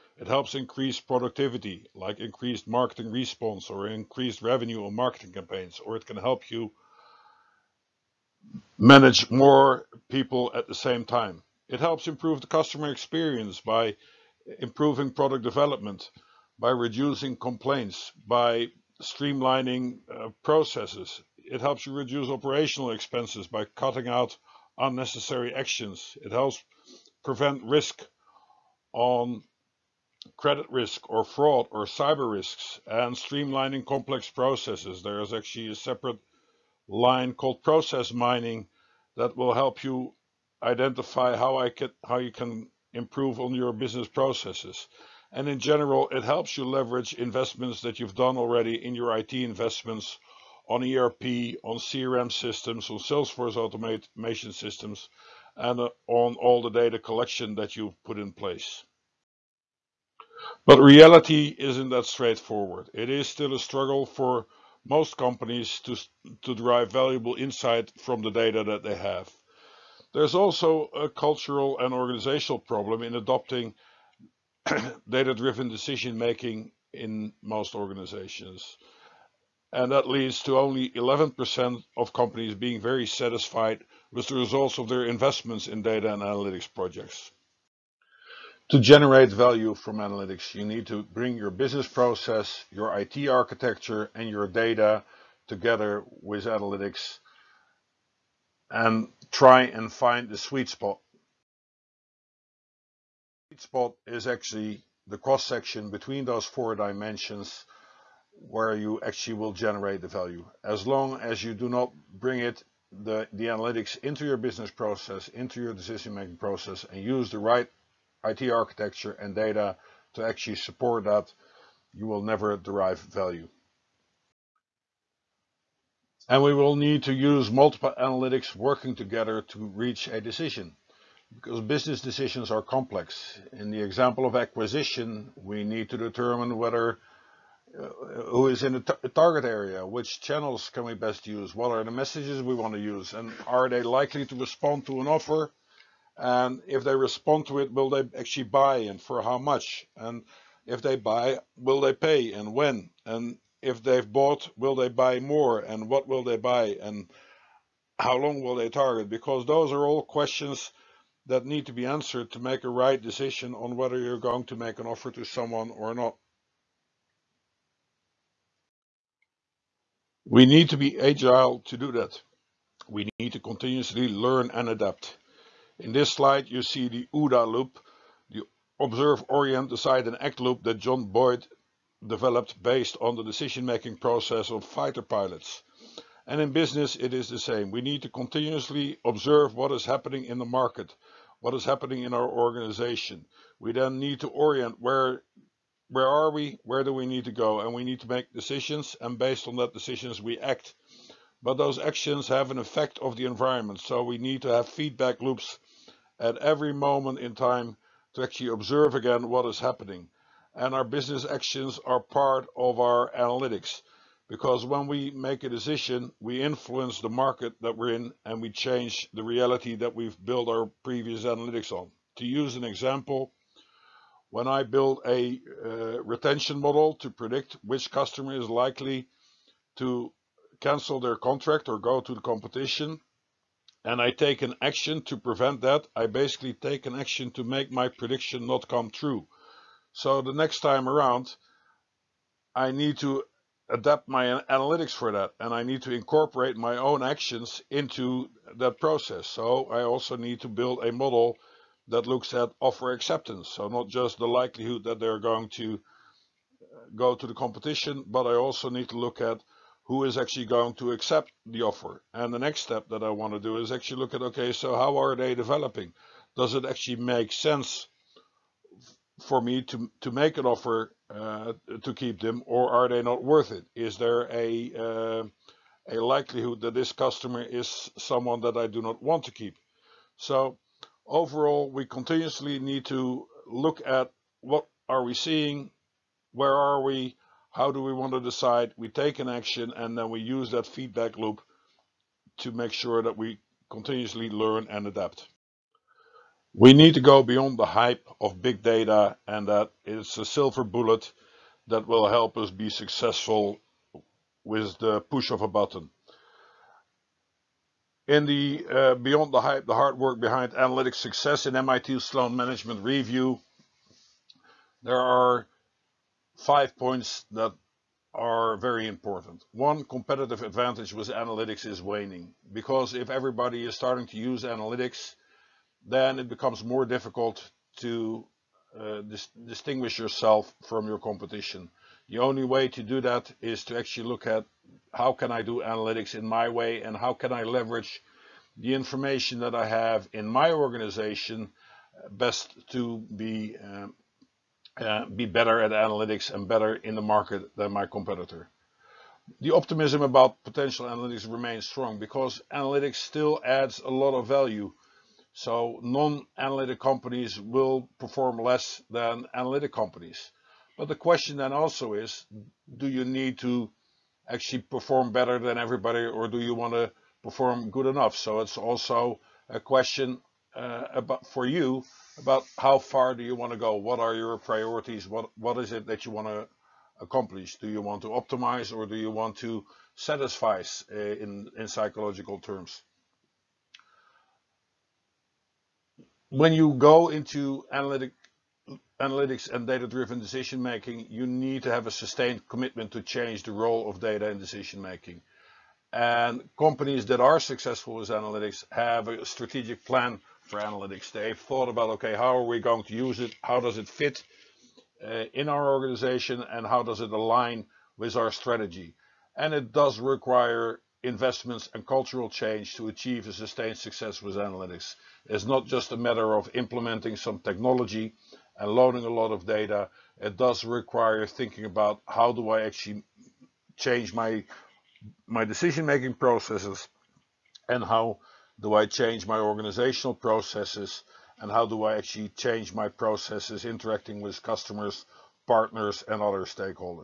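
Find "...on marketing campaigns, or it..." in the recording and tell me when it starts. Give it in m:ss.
0:04.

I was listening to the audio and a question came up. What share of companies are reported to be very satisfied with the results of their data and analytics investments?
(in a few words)
11%.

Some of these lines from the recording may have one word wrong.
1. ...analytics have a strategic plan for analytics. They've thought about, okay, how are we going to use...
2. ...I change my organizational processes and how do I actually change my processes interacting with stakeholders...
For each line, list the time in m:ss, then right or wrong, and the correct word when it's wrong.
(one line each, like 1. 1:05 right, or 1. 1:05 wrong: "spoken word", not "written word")
1. 6:38 right
2. 7:08 wrong: "customers", not "stakeholders".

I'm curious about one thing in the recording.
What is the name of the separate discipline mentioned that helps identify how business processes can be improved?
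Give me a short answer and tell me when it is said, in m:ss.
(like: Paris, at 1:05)
Process mining, at 0:37.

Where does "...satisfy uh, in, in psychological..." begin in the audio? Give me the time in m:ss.
6:19.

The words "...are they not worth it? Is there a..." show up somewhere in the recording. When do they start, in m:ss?
4:32.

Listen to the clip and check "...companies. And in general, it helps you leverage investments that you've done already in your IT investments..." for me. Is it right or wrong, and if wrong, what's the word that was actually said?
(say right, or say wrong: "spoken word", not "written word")
wrong: "processes", not "companies".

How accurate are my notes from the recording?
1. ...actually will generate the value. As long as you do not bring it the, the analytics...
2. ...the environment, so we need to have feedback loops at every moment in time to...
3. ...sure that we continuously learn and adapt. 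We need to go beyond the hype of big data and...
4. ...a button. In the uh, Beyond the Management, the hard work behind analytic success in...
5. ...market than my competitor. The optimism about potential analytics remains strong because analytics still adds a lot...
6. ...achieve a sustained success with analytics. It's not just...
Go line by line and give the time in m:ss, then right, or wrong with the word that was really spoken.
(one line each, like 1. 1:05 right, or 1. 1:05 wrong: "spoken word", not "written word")
1. 1:49 right
2. 3:23 right
3. 4:52 right
4. 5:05 wrong: "Hype", not "Management"
5. 5:47 right
6. 6:52 right.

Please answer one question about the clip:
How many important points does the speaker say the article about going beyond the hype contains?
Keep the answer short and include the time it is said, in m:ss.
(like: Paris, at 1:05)
5, at 5:16.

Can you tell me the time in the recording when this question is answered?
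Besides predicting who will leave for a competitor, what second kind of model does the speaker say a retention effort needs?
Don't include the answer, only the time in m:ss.
4:12.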